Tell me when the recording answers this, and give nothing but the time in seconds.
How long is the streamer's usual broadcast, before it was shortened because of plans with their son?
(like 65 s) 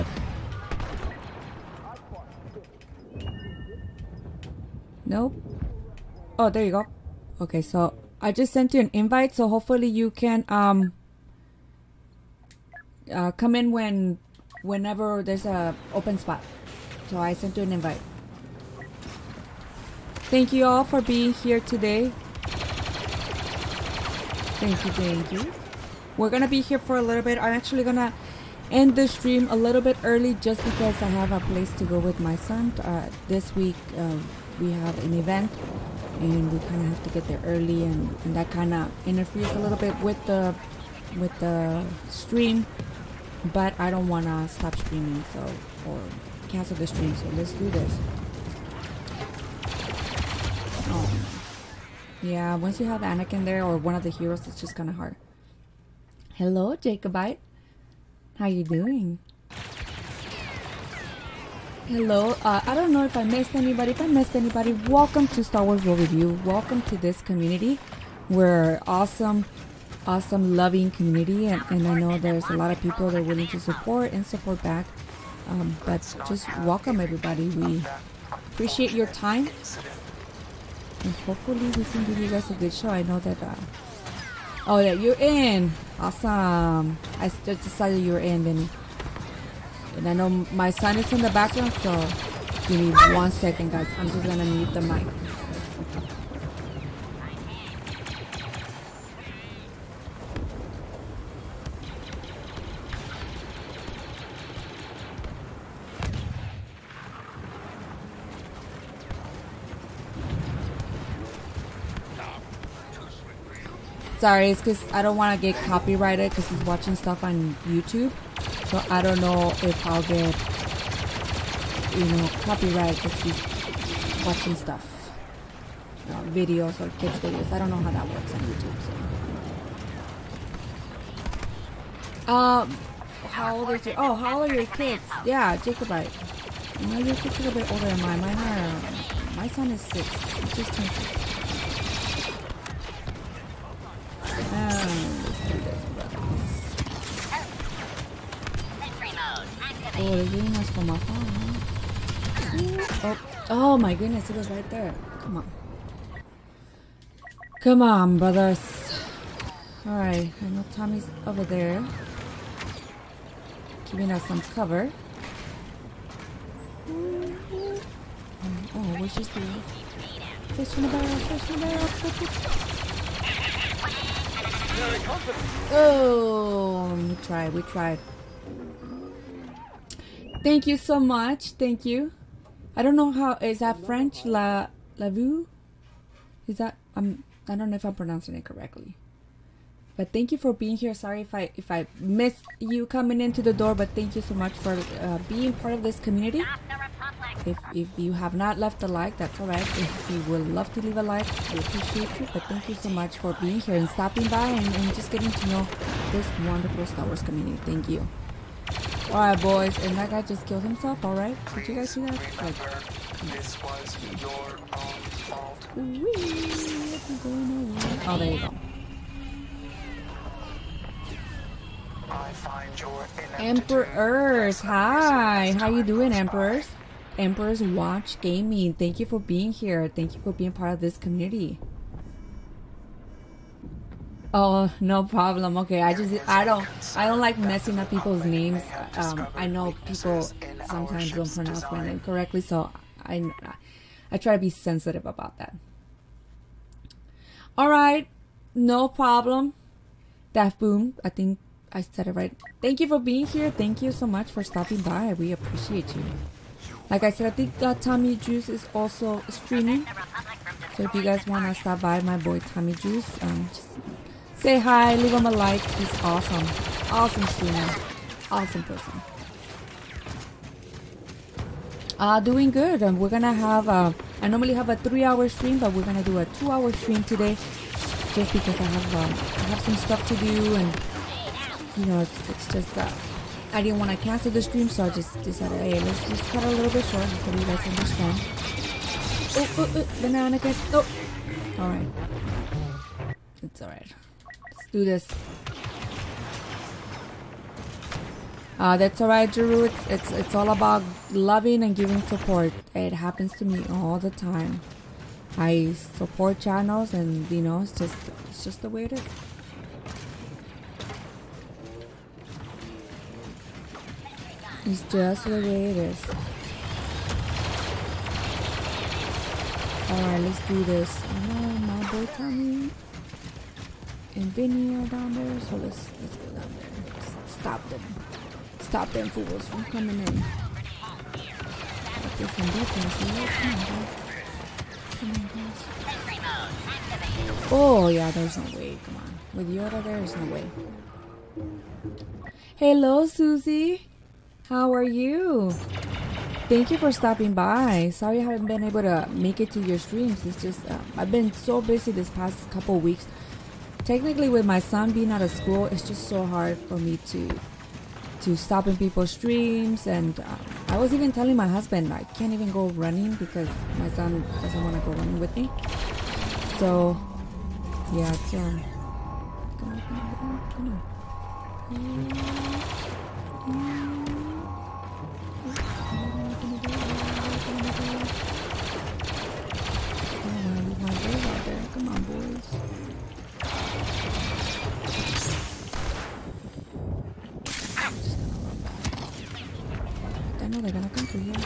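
274 s.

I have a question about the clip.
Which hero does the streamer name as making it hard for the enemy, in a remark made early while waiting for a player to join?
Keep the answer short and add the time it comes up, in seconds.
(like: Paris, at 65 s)
Anakin, at 53 s.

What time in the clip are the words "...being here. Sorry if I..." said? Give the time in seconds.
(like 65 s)
190 s.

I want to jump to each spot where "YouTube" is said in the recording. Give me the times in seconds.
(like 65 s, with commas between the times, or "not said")
117 s, 128 s.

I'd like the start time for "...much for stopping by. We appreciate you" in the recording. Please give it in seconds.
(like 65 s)
254 s.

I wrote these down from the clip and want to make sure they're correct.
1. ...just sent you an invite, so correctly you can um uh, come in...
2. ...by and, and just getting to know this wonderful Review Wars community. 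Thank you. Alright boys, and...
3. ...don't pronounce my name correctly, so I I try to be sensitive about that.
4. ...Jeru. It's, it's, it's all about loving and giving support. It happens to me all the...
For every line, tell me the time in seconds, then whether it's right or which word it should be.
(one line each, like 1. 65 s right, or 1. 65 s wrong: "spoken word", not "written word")
1. 8 s wrong: "hopefully", not "correctly"
2. 204 s wrong: "Star", not "Review"
3. 241 s right
4. 299 s right.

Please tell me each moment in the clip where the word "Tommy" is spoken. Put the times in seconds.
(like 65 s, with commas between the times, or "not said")
160 s, 257 s, 262 s, 322 s.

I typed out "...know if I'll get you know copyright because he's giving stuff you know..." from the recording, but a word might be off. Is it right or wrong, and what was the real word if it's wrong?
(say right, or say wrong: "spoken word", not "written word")
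wrong: "watching", not "giving".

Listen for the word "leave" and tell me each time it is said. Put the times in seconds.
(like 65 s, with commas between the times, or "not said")
200 s, 264 s.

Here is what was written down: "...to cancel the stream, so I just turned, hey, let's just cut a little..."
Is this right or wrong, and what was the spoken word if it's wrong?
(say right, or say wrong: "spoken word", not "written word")
wrong: "decided", not "turned".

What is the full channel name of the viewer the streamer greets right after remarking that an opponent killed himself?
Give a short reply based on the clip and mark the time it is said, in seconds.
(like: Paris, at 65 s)
Emperors Watch Gaming, at 227 s.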